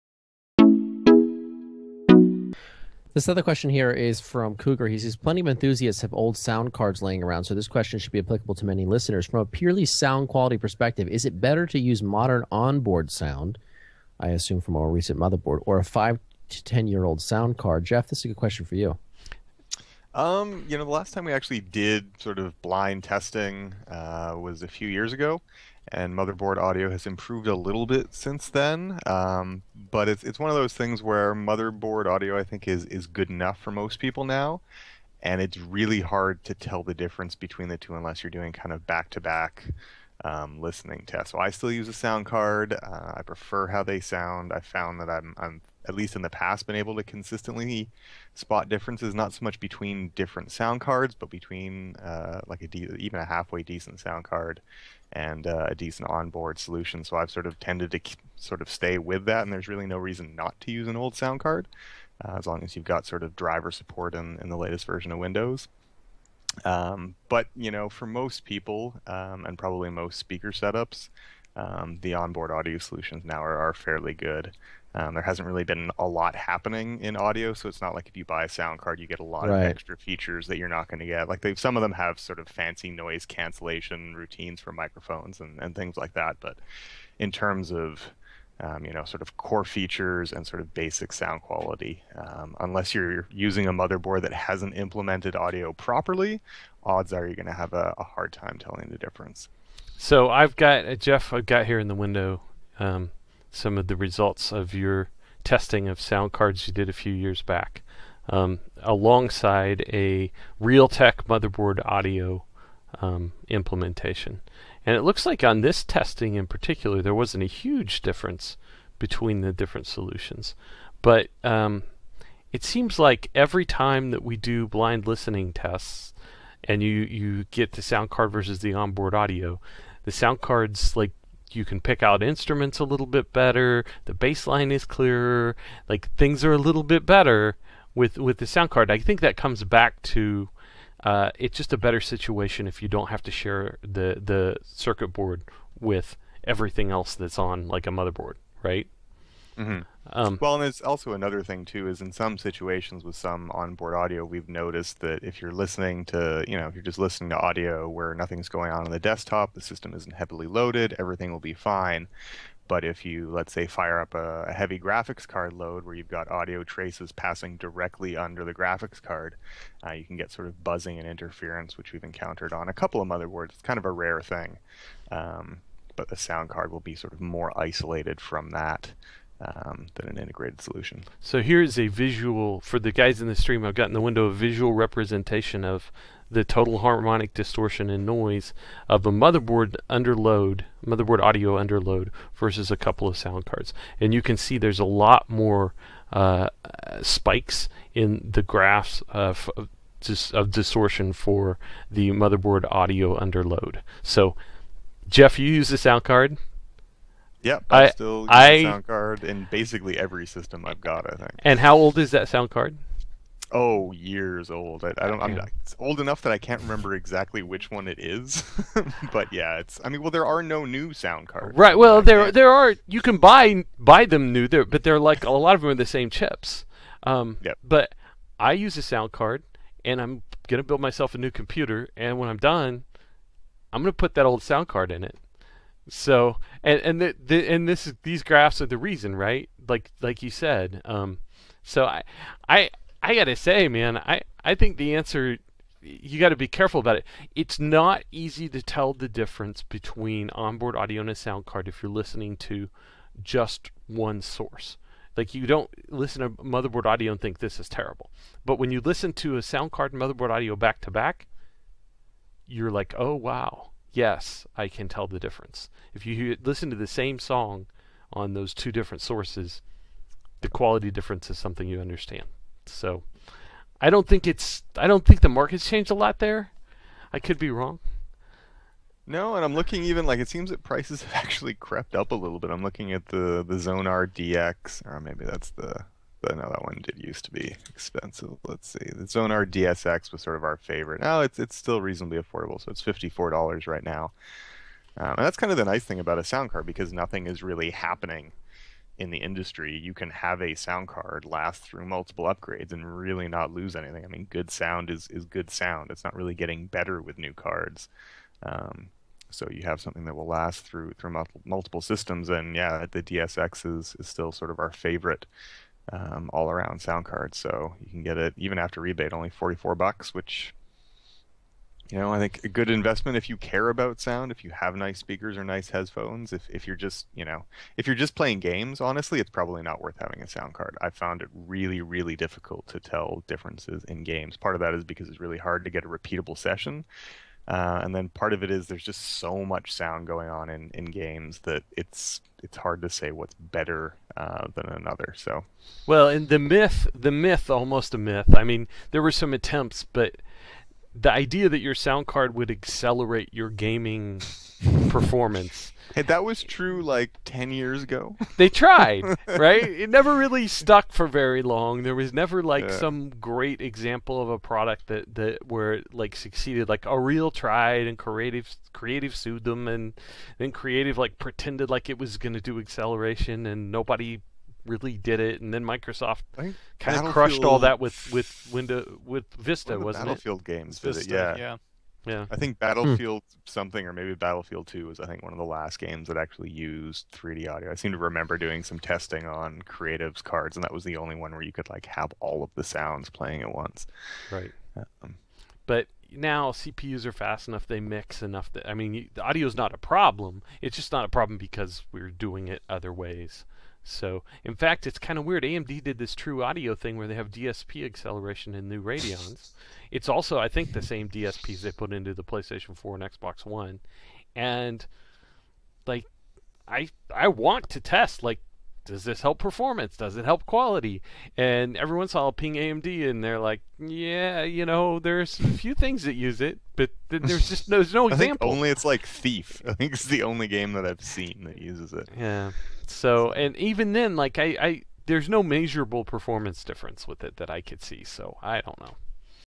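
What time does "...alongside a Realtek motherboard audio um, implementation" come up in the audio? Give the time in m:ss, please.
1:48.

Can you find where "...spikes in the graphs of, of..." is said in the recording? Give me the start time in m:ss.
3:17.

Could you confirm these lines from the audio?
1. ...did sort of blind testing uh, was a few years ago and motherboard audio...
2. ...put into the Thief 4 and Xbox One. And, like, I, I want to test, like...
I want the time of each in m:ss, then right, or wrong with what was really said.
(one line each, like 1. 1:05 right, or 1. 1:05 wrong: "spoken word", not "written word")
1. 0:21 right
2. 6:51 wrong: "PlayStation", not "Thief".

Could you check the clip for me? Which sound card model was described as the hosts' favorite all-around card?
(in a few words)
Xonar DSX.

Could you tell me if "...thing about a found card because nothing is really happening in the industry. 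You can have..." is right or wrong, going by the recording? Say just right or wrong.
wrong.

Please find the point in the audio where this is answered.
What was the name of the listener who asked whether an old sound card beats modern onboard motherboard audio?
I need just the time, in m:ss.
0:04.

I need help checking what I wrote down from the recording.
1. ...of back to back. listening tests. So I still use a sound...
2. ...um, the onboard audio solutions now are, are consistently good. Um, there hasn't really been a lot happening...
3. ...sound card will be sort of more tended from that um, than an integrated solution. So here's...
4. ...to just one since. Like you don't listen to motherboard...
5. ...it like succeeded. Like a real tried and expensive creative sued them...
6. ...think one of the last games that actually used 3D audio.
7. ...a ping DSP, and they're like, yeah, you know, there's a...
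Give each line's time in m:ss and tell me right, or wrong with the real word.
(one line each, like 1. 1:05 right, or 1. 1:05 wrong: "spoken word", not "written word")
1. 0:38 right
2. 1:11 wrong: "fairly", not "consistently"
3. 2:56 wrong: "isolated", not "tended"
4. 4:12 wrong: "source", not "since"
5. 6:05 wrong: "creative", not "expensive"
6. 6:25 right
7. 7:02 wrong: "AMD", not "DSP".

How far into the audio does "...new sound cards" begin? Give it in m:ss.
3:40.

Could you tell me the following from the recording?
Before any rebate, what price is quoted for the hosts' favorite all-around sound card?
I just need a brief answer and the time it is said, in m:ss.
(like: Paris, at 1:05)
$54, at 4:52.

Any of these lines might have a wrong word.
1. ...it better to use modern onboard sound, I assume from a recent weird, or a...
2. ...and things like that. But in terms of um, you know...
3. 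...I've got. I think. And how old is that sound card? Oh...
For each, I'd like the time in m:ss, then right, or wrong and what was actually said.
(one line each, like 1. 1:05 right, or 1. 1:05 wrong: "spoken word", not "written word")
1. 0:11 wrong: "motherboard", not "weird"
2. 1:25 right
3. 3:30 right.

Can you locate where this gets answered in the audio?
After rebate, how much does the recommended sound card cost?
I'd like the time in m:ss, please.
5:19.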